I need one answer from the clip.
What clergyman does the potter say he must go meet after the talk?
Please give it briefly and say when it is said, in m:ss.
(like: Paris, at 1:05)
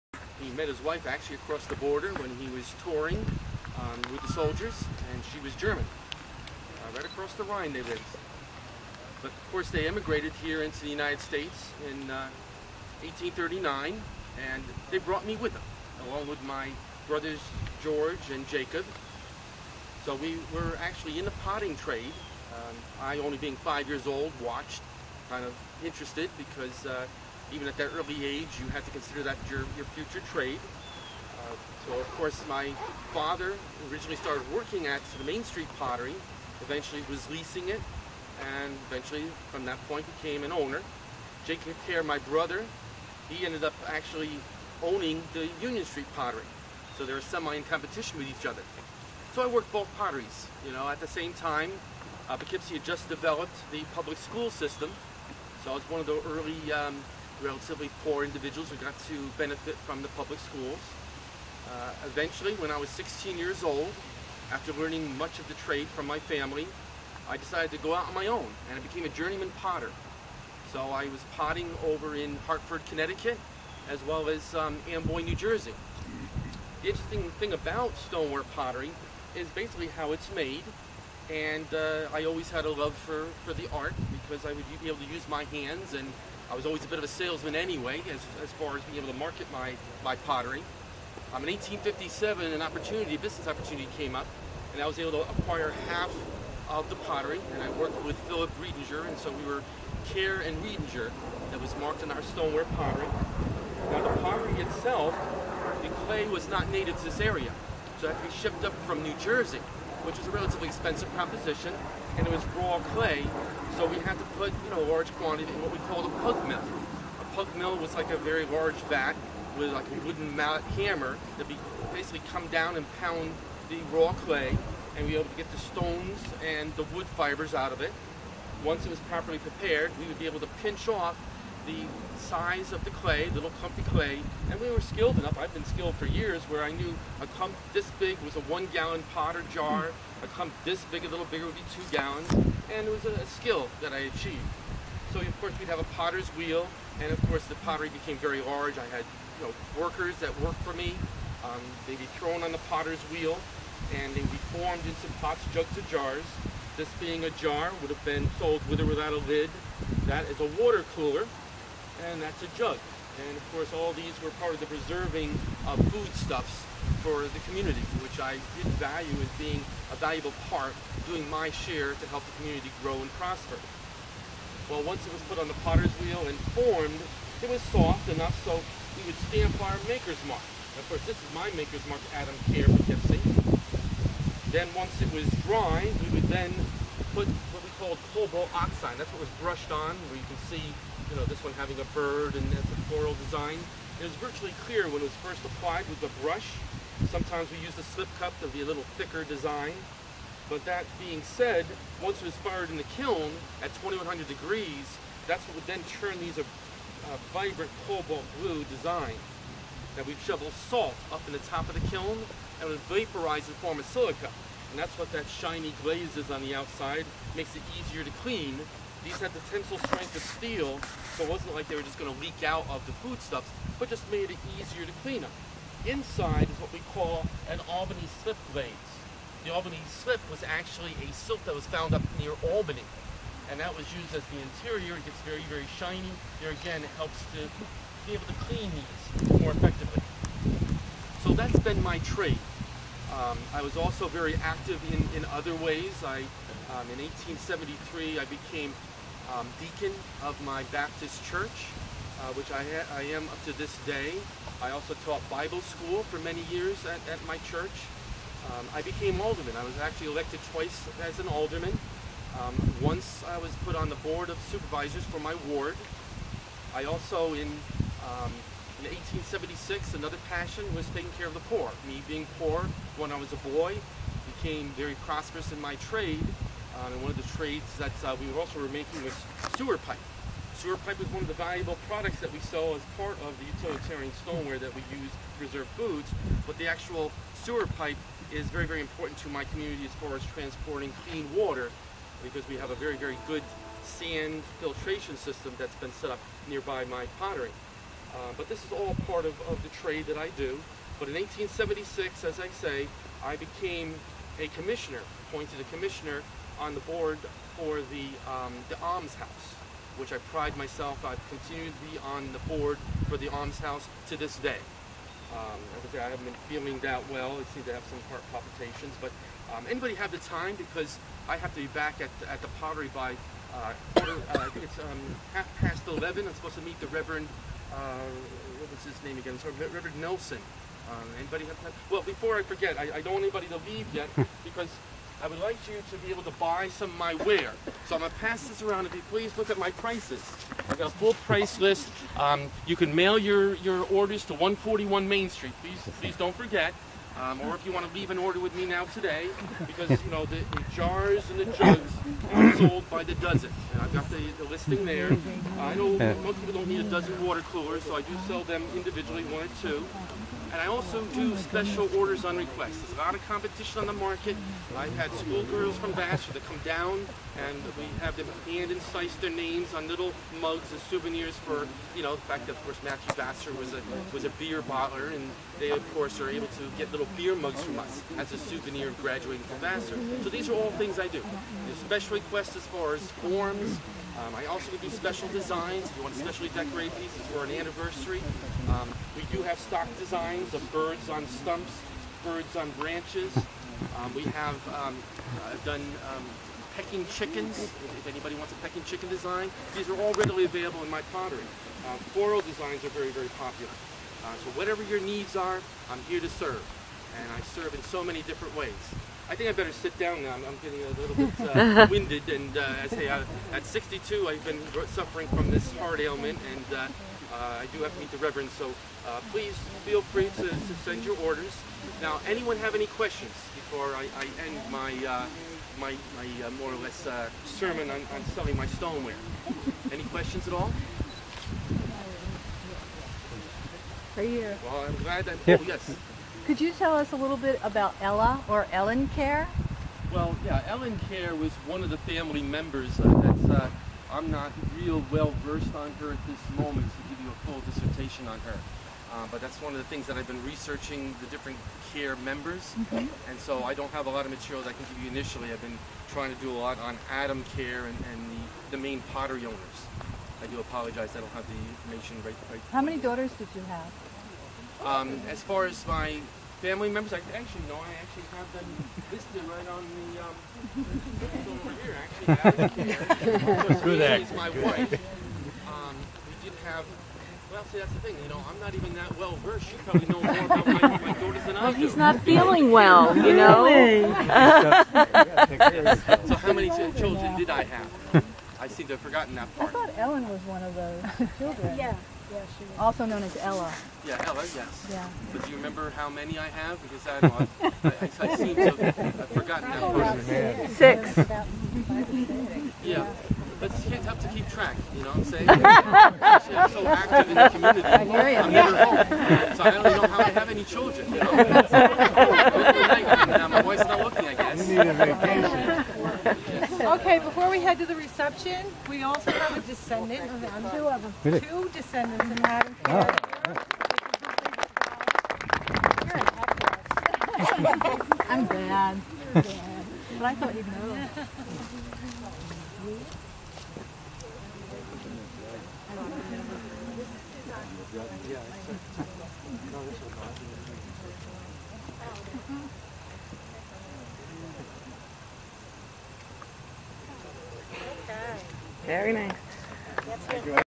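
Reverend Nelson, at 5:29.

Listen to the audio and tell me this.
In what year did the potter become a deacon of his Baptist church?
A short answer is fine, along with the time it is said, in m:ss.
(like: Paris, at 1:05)
1873, at 4:07.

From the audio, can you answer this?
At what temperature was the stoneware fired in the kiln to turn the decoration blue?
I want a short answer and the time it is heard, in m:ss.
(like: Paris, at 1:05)
2100 degrees, at 3:23.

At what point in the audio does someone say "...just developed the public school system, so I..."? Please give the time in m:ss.
0:52.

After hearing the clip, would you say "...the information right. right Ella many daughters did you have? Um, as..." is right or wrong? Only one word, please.
wrong.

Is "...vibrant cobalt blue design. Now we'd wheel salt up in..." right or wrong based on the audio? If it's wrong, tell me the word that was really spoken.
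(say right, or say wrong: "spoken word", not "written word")
wrong: "shovel", not "wheel".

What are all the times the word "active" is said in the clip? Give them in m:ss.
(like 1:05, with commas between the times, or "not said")
4:04, 8:26.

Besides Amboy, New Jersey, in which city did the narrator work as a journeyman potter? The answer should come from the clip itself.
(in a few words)
Hartford, Connecticut.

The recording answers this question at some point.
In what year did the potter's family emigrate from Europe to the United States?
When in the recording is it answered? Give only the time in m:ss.
0:13.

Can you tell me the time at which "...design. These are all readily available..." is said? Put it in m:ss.
6:39.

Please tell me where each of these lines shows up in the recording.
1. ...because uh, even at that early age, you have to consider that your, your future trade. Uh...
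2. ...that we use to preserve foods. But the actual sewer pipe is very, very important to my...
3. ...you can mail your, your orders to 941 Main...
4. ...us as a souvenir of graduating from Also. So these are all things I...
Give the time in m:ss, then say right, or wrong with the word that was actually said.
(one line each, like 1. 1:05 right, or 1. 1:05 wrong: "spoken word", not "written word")
1. 0:26 right
2. 4:44 right
3. 5:42 wrong: "141", not "941"
4. 6:17 wrong: "Vassar", not "Also".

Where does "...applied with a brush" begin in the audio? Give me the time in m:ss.
3:15.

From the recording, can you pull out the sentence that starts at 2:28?
I had you know, workers that worked for me.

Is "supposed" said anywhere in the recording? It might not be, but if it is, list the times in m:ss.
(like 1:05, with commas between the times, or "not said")
5:26.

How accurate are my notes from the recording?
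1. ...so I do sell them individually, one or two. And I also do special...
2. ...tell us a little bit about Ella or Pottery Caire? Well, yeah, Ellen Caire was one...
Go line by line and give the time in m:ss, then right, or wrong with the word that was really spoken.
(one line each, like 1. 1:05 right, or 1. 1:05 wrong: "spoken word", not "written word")
1. 5:57 right
2. 7:16 wrong: "Ellen", not "Pottery".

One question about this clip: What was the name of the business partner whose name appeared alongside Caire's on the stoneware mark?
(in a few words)
Philip Riedinger.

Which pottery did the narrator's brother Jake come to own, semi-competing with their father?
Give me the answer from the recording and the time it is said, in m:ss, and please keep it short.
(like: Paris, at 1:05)
Union Street Pottery, at 0:45.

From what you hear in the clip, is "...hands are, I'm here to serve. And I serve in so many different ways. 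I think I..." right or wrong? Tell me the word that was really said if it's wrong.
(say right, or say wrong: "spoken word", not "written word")
wrong: "needs", not "hands".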